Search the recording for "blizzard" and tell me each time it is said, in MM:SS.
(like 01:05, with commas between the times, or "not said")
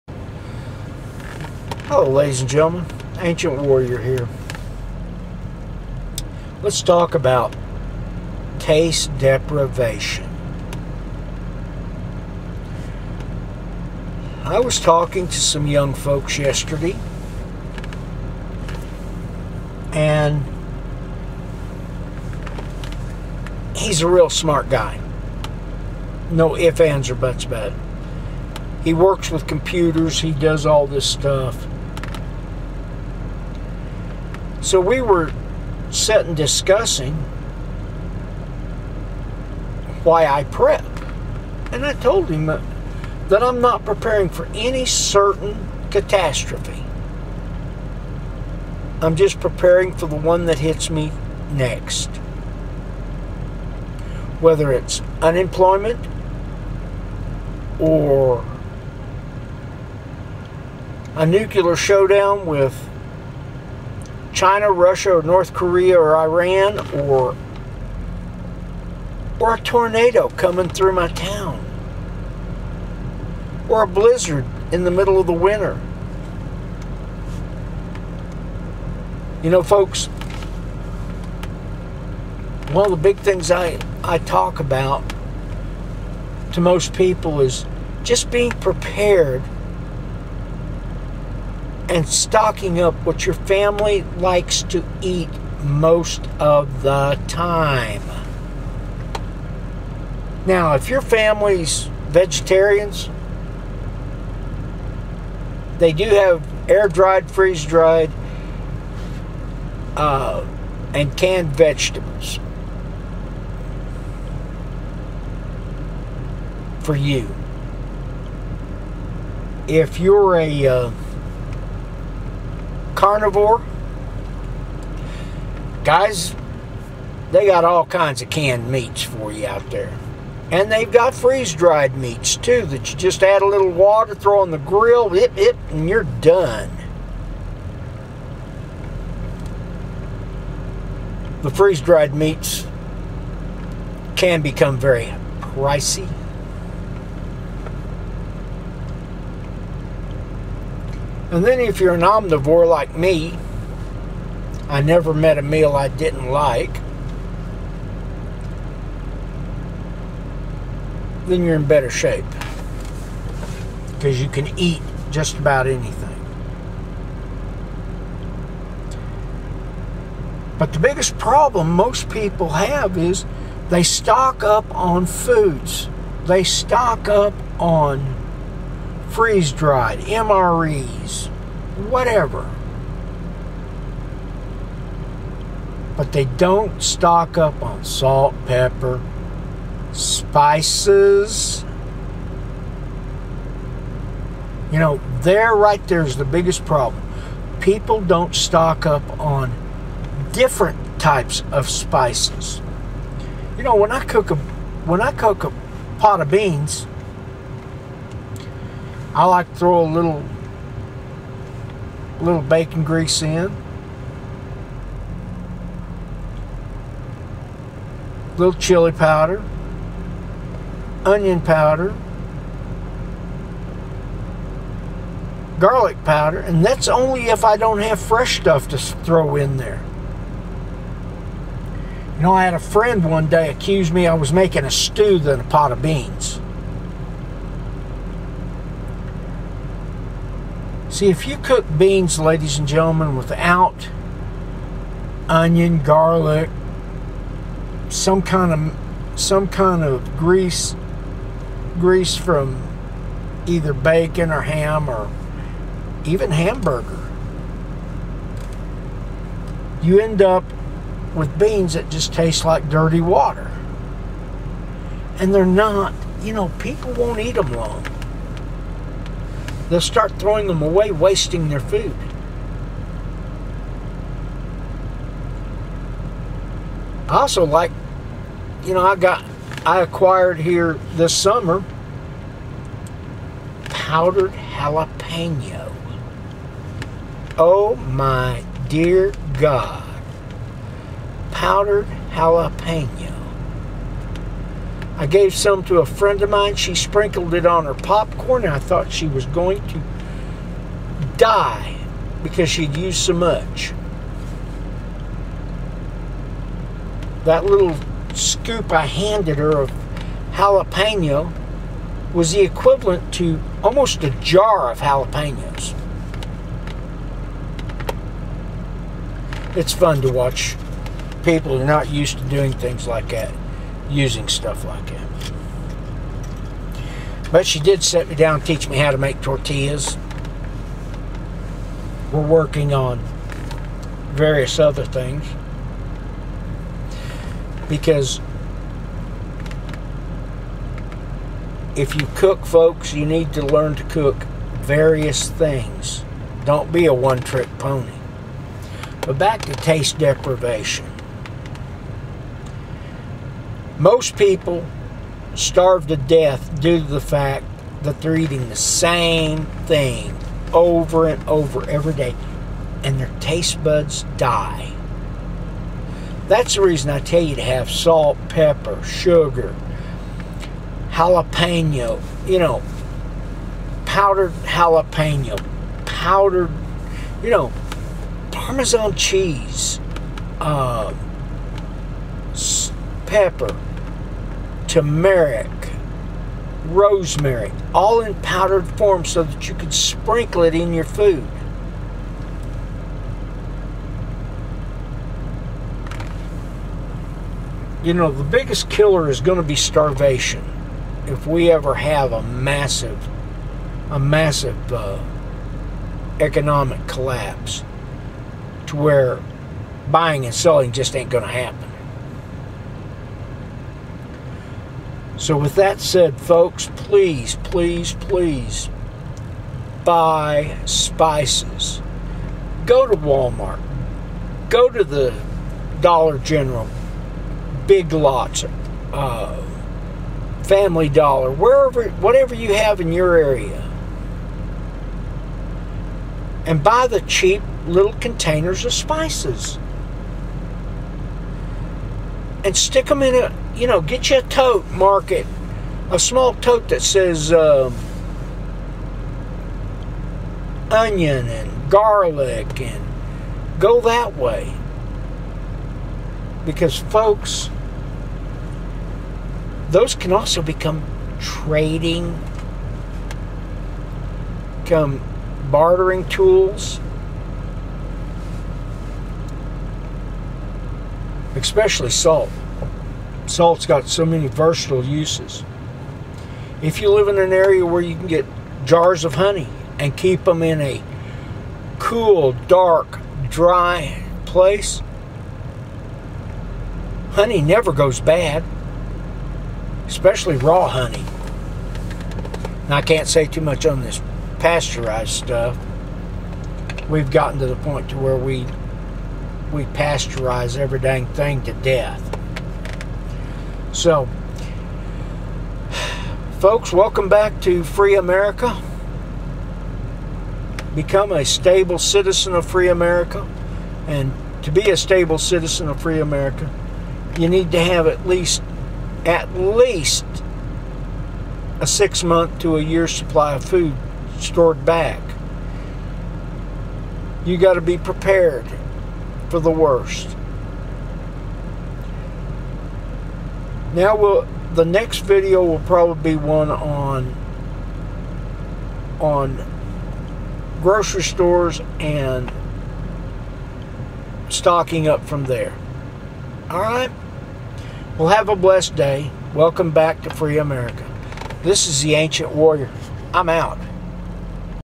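01:13.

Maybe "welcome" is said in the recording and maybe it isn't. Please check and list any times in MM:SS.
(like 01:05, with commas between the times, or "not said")
08:26, 09:09.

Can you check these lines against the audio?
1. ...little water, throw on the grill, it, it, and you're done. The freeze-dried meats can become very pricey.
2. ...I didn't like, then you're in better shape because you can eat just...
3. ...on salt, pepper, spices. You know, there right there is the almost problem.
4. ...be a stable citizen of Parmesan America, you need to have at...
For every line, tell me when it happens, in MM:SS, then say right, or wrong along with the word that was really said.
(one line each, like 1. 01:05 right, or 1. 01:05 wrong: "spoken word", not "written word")
1. 02:13 right
2. 02:35 right
3. 03:07 wrong: "biggest", not "almost"
4. 08:34 wrong: "Free", not "Parmesan".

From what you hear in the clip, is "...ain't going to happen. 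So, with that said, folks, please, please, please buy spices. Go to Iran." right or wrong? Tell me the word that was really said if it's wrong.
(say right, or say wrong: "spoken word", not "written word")
wrong: "Walmart", not "Iran".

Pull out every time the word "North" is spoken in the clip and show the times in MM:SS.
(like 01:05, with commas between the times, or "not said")
01:05.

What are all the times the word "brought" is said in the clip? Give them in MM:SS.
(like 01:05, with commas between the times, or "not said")
not said.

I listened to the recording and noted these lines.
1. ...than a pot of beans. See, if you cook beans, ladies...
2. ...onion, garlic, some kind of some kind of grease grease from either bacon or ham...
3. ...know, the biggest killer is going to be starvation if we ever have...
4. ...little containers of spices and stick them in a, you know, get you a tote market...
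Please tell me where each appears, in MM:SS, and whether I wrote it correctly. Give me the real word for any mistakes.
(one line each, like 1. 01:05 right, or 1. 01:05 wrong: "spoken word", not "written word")
1. 03:55 right
2. 04:05 right
3. 06:37 right
4. 07:17 right.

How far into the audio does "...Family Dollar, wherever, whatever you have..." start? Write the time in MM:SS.
07:10.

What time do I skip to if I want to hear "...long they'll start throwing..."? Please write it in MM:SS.
04:27.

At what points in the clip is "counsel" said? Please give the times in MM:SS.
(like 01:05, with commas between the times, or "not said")
not said.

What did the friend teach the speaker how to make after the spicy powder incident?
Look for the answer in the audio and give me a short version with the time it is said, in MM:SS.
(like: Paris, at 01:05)
tortillas, at 05:29.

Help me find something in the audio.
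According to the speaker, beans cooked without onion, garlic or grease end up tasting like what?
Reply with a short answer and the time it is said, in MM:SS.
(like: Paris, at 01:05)
dirty water, at 04:22.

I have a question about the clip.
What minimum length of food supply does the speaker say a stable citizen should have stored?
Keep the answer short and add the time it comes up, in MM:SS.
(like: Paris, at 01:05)
6 months, at 08:41.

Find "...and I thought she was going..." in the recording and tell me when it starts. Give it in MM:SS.
04:58.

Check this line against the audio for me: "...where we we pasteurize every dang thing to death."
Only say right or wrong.
right.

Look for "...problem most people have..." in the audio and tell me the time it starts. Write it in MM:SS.
02:51.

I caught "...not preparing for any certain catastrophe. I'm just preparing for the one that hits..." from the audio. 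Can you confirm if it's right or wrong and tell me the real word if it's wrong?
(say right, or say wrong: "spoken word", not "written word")
right.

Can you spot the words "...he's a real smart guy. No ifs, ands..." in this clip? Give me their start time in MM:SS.
00:23.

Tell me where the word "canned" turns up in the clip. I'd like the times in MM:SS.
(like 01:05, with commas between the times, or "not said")
01:51, 02:08.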